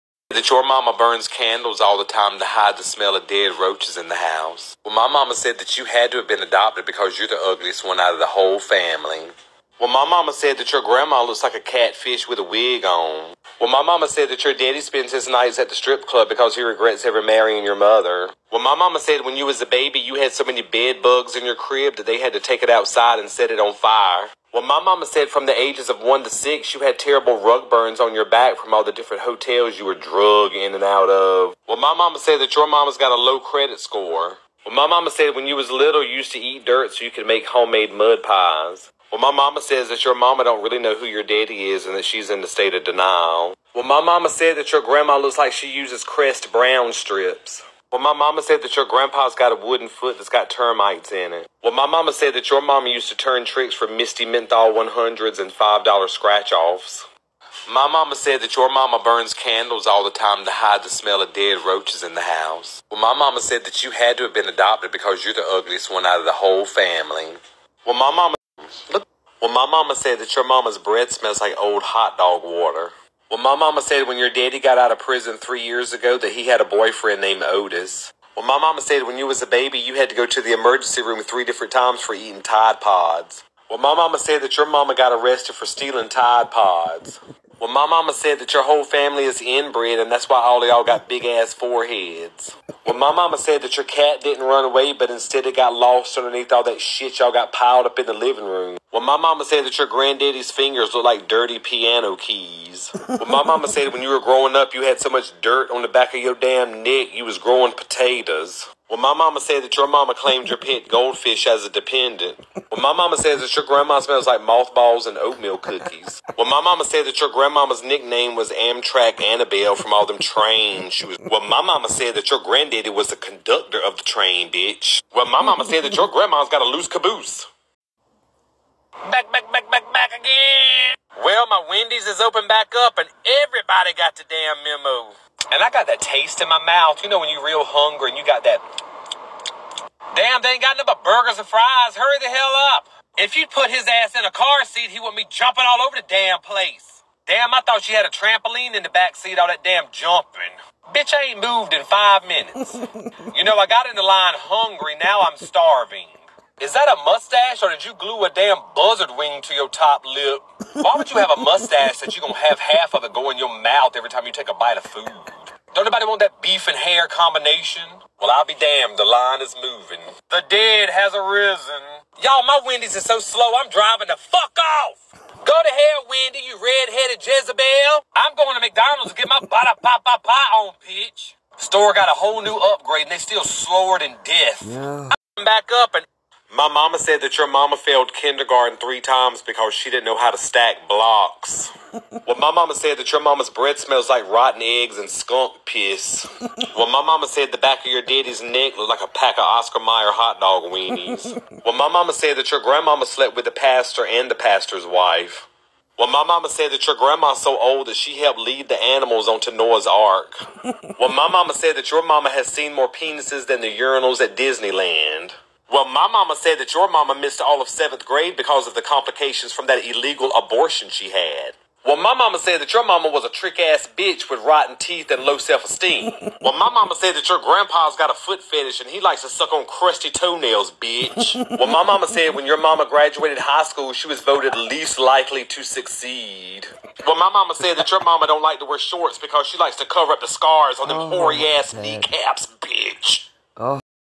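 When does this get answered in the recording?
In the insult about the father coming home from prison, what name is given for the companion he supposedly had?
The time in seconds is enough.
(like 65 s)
77 s.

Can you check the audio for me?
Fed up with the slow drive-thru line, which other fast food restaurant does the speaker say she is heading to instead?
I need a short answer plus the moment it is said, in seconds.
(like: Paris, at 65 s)
McDonald's, at 178 s.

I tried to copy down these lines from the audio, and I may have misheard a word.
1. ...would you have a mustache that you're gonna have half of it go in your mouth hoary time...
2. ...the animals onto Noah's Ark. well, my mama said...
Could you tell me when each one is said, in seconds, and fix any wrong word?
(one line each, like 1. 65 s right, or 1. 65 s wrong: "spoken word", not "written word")
1. 160 s wrong: "every", not "hoary"
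2. 208 s right.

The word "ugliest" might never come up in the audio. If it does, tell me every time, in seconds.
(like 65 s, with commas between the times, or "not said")
7 s, 65 s.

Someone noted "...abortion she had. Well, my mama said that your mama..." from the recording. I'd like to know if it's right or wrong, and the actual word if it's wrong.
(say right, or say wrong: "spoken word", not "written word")
right.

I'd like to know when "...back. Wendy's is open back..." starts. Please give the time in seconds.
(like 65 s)
129 s.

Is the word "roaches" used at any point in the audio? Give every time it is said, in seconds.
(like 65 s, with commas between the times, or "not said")
3 s, 61 s.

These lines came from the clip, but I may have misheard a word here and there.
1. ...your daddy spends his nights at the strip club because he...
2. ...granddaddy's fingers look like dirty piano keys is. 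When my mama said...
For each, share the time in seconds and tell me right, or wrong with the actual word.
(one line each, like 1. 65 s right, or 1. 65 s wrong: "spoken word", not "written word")
1. 14 s right
2. 99 s right.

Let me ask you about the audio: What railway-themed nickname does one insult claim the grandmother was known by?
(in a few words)
Amtrak Annabelle.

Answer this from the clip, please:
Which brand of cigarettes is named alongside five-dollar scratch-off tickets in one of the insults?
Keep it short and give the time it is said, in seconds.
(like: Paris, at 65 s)
Misty Menthol 100s, at 53 s.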